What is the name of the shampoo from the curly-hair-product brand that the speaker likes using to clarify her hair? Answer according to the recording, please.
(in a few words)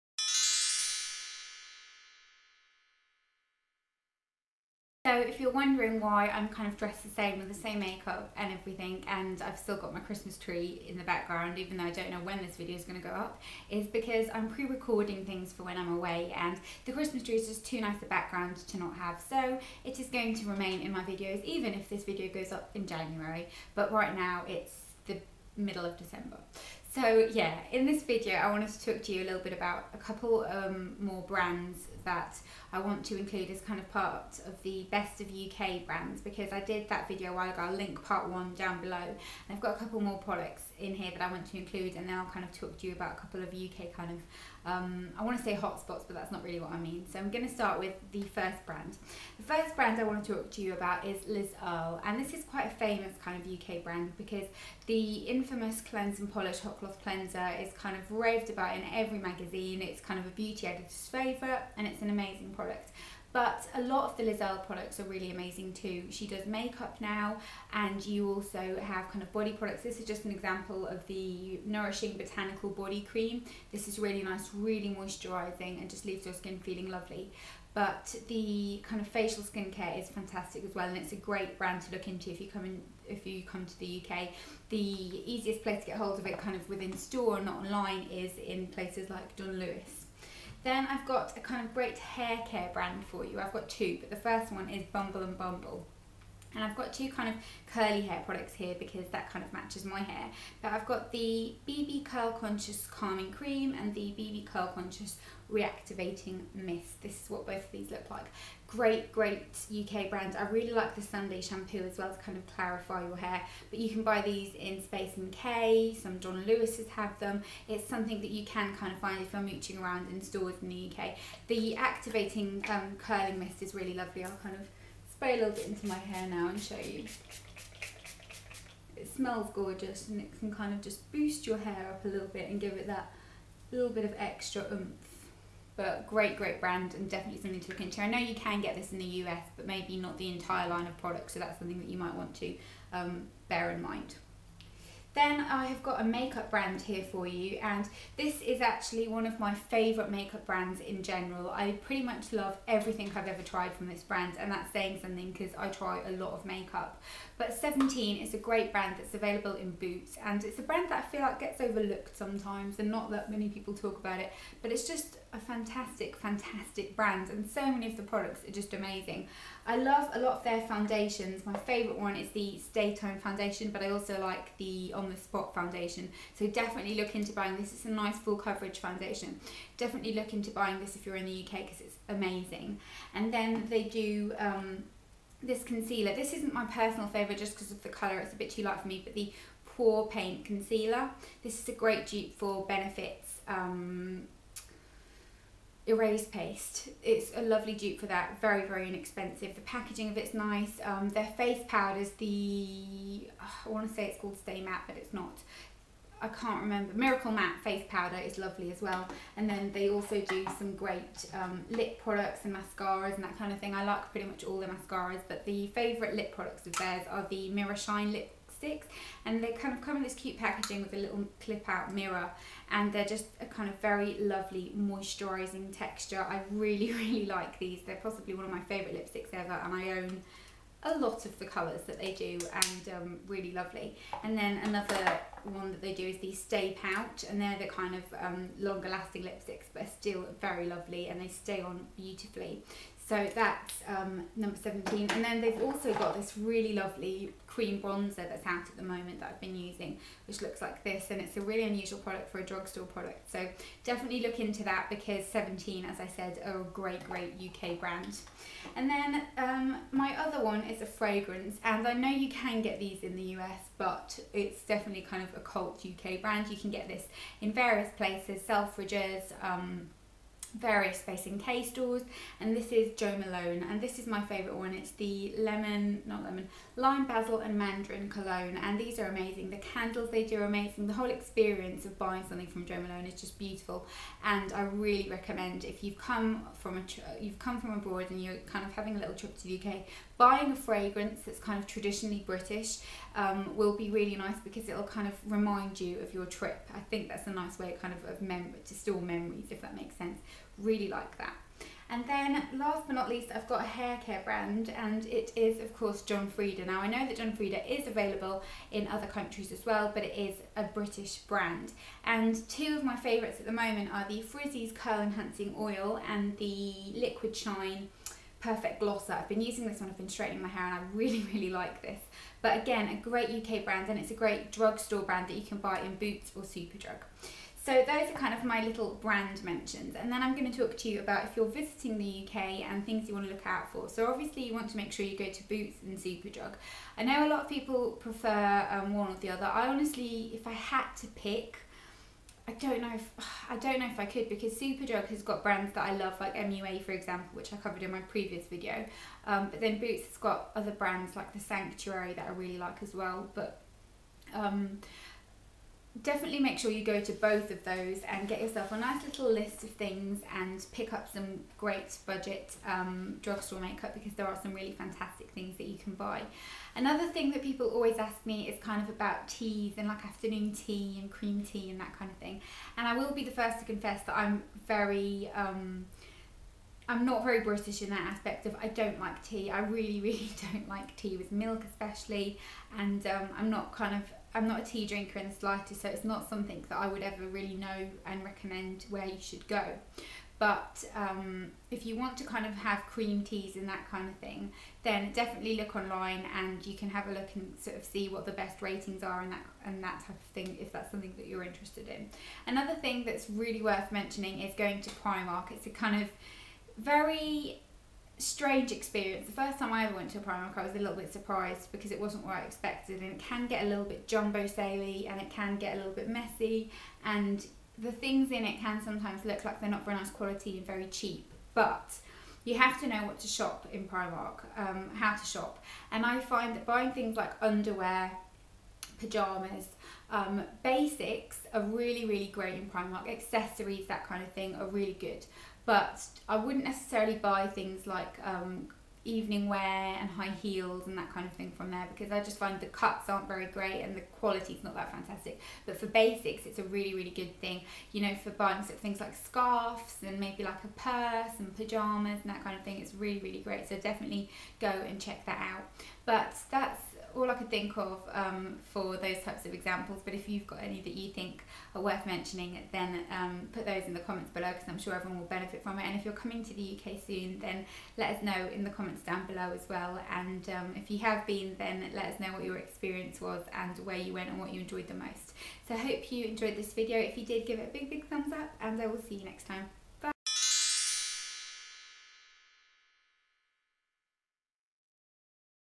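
Sunday shampoo.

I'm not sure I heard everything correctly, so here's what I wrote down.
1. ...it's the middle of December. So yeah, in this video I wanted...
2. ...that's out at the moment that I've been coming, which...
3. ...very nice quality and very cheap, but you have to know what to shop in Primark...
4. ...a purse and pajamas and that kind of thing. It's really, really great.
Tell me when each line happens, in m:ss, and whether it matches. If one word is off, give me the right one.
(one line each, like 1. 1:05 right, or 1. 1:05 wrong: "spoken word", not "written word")
1. 0:24 right
2. 4:08 wrong: "using", not "coming"
3. 6:59 right
4. 7:30 right.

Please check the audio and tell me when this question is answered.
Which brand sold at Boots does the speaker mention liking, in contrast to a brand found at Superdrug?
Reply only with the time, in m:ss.
5:51.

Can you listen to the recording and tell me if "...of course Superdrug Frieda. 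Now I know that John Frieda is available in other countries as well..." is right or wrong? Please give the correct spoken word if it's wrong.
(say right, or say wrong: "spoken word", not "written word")
wrong: "John", not "Superdrug".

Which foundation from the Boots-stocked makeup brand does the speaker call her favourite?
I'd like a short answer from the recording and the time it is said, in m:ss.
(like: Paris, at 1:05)
Stay Time, at 2:52.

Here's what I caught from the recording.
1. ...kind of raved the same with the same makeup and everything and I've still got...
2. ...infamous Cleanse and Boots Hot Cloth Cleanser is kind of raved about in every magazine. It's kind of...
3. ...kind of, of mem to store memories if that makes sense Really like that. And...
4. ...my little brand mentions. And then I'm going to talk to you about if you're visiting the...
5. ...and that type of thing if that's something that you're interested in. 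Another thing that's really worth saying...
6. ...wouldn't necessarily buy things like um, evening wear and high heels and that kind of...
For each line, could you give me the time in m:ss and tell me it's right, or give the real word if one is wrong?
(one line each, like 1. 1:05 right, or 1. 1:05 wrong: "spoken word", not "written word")
1. 0:06 wrong: "dressed", not "raved"
2. 0:55 wrong: "Polish", not "Boots"
3. 4:57 right
4. 5:28 right
5. 6:39 wrong: "mentioning", not "saying"
6. 7:16 right.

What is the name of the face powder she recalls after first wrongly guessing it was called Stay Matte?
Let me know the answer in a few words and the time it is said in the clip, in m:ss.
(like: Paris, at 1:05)
Miracle Matte, at 3:26.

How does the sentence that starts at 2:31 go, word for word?
I pretty much love everything I've ever tried from this brand and that's saying something because I try a lot of makeup.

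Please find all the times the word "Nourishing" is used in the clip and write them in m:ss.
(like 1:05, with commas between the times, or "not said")
1:11.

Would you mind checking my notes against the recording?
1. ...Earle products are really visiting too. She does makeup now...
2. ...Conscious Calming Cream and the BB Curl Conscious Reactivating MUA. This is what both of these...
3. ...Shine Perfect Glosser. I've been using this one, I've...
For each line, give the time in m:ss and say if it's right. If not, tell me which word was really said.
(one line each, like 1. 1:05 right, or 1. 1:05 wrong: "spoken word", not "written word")
1. 1:04 wrong: "amazing", not "visiting"
2. 1:42 wrong: "Mist", not "MUA"
3. 5:17 right.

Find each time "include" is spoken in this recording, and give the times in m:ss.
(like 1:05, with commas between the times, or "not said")
0:33, 0:41.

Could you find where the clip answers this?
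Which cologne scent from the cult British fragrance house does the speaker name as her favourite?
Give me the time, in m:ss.
4:36.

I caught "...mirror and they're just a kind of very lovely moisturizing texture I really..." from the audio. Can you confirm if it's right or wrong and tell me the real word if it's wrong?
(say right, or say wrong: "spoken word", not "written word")
right.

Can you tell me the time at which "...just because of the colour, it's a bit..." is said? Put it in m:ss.
3:07.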